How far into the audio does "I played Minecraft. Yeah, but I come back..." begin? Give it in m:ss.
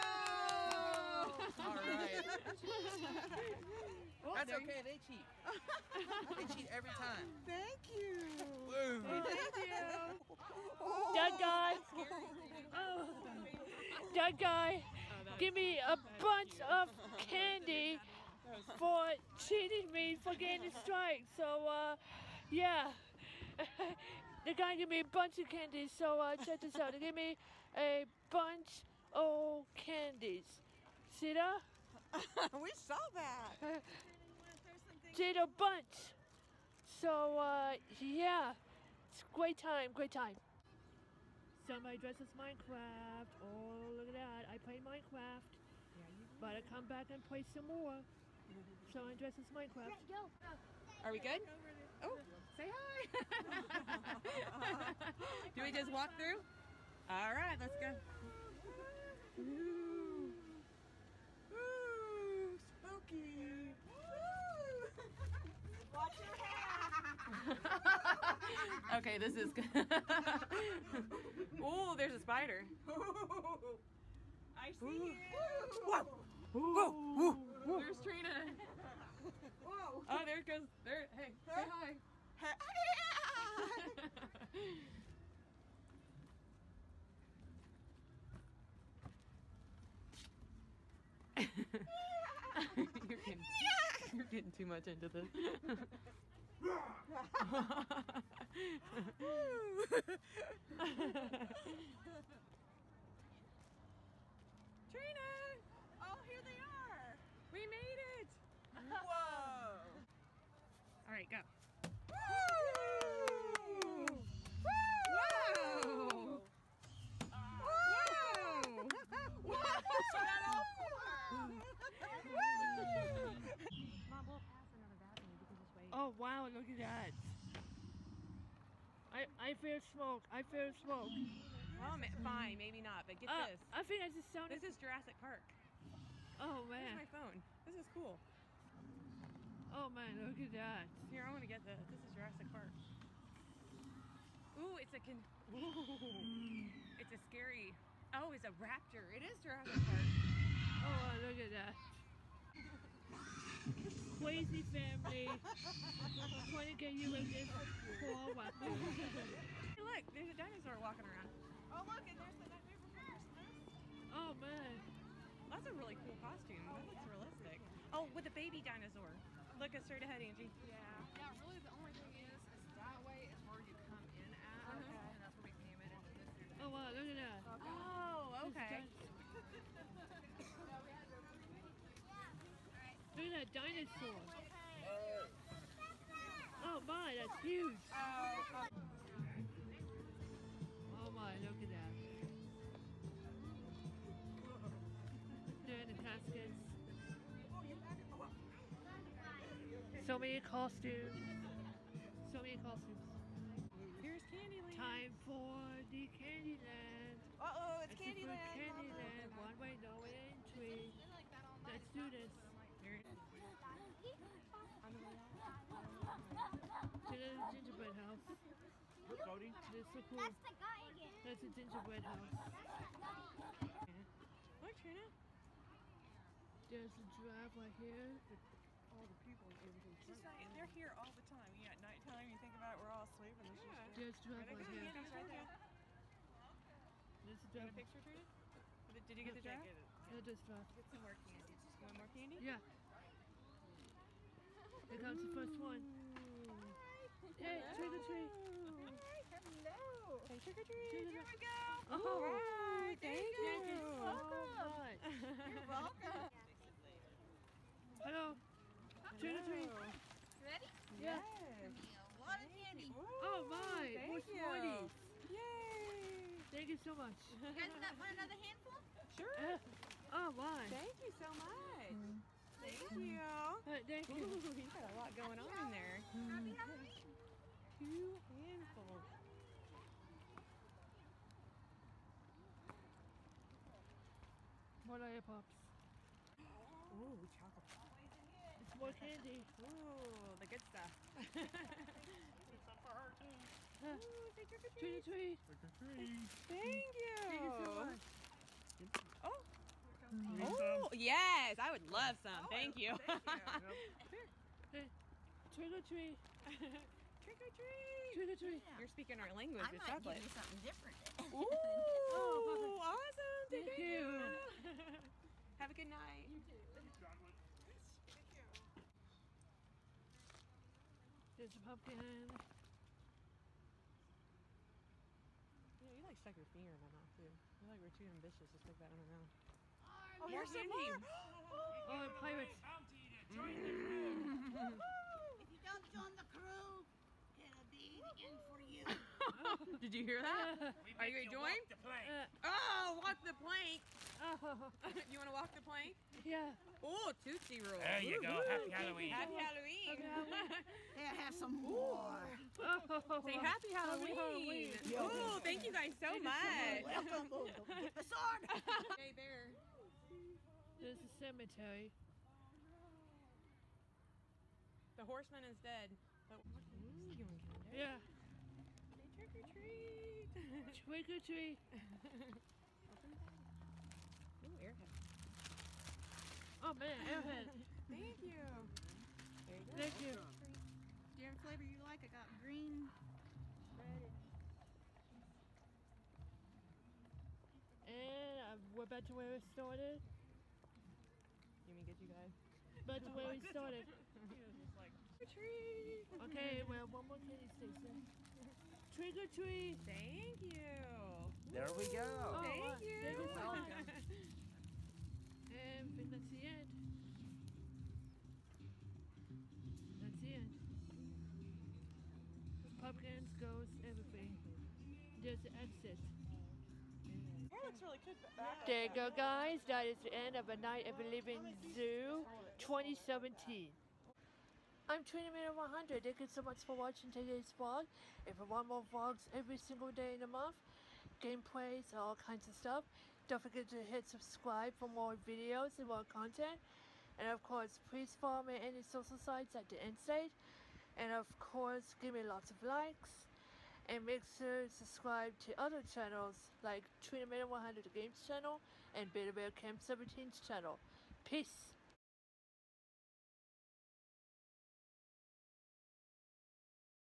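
0:44.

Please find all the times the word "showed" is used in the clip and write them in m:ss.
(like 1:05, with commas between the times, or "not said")
not said.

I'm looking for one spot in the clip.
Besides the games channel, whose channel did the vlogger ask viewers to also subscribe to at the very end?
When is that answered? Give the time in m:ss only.
7:29.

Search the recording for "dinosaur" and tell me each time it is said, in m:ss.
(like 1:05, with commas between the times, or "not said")
2:40, 2:48, 3:03.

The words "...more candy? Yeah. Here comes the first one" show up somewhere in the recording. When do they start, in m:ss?
4:01.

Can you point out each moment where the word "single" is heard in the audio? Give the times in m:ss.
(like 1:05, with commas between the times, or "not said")
7:09.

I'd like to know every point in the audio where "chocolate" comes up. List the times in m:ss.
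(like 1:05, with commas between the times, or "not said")
4:47, 5:09.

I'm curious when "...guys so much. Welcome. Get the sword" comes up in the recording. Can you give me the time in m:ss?
5:55.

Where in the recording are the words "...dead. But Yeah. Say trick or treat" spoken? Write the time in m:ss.
6:05.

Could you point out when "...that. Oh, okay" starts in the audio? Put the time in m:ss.
2:57.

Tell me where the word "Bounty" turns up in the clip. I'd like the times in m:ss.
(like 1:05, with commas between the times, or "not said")
5:32.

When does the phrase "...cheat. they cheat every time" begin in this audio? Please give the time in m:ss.
0:04.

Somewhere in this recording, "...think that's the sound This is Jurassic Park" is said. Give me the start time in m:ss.
2:13.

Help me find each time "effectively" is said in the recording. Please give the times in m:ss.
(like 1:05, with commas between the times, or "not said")
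not said.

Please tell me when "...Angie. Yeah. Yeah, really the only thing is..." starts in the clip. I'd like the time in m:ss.
2:50.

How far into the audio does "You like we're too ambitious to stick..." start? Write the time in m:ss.
5:27.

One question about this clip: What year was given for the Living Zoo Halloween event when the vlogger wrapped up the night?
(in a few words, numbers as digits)
2017.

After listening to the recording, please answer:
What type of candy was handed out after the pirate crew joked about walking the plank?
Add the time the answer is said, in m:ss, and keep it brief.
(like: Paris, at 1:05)
Tootsie Roll, at 5:47.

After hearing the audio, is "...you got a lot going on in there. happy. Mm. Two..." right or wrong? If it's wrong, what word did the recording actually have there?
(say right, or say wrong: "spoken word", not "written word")
right.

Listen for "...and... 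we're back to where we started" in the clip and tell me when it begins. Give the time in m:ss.
6:27.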